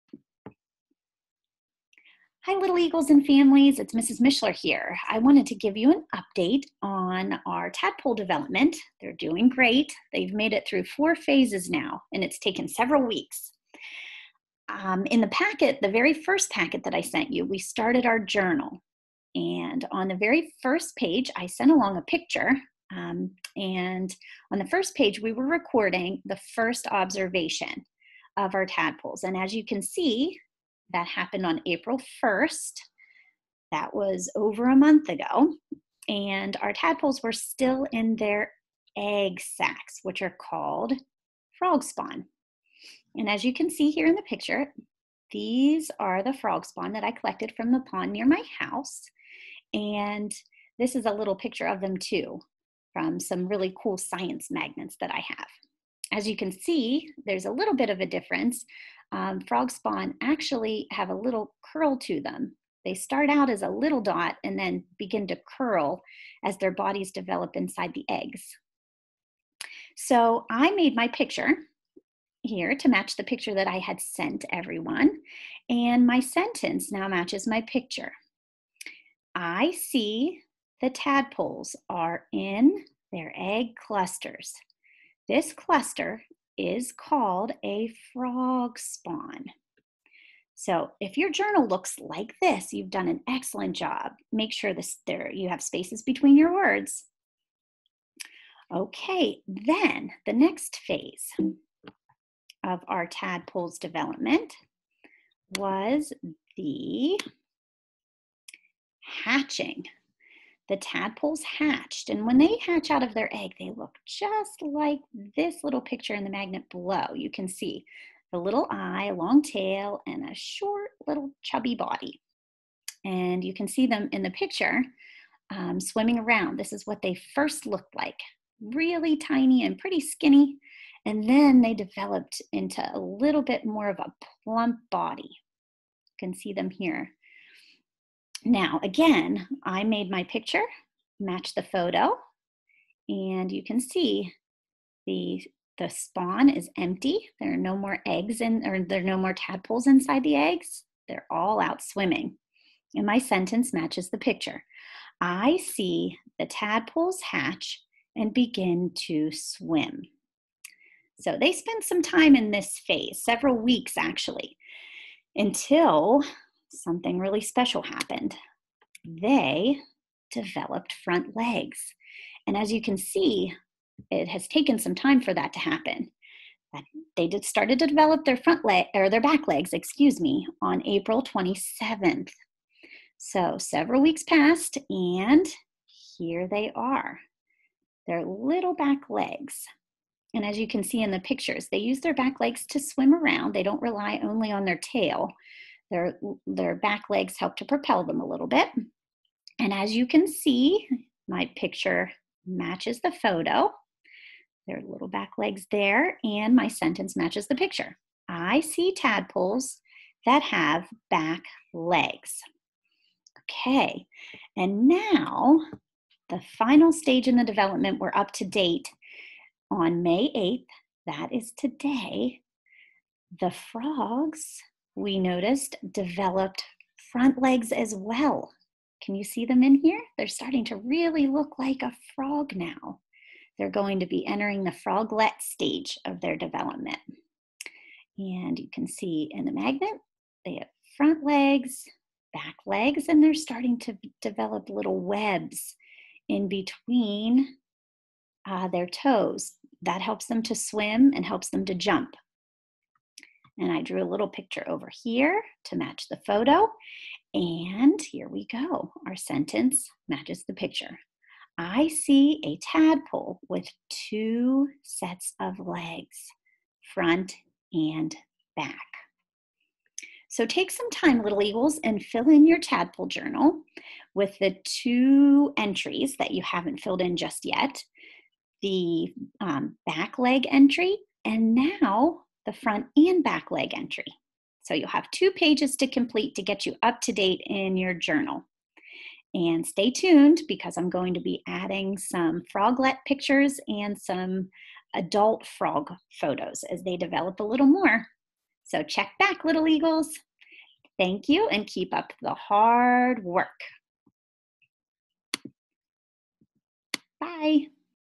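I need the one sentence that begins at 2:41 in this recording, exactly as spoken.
So they spend some time in this phase, several weeks actually, until something really special happened.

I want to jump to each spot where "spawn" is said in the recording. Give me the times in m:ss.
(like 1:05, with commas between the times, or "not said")
0:41, 0:46, 0:59, 1:28, 2:25.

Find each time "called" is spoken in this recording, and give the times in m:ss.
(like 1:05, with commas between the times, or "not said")
0:40, 1:26.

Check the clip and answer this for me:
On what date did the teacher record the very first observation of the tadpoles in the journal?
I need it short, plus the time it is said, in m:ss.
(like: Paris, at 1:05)
April 1, at 0:31.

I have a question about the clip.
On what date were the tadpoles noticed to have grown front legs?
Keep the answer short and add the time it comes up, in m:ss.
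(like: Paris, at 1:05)
May 8, at 3:40.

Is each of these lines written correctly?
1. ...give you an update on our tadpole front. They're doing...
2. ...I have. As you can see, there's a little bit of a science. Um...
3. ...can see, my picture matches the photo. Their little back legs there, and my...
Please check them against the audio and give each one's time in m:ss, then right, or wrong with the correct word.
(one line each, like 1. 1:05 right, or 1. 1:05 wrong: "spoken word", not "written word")
1. 0:05 wrong: "development", not "front"
2. 0:55 wrong: "difference", not "science"
3. 3:20 right.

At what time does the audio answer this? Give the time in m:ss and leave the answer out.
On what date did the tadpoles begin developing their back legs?
3:00.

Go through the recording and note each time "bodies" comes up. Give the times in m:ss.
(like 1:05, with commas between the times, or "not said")
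1:06.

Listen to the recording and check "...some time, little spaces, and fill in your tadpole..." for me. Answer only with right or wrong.
wrong.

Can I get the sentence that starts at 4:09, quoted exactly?
That helps them to swim and helps them to jump.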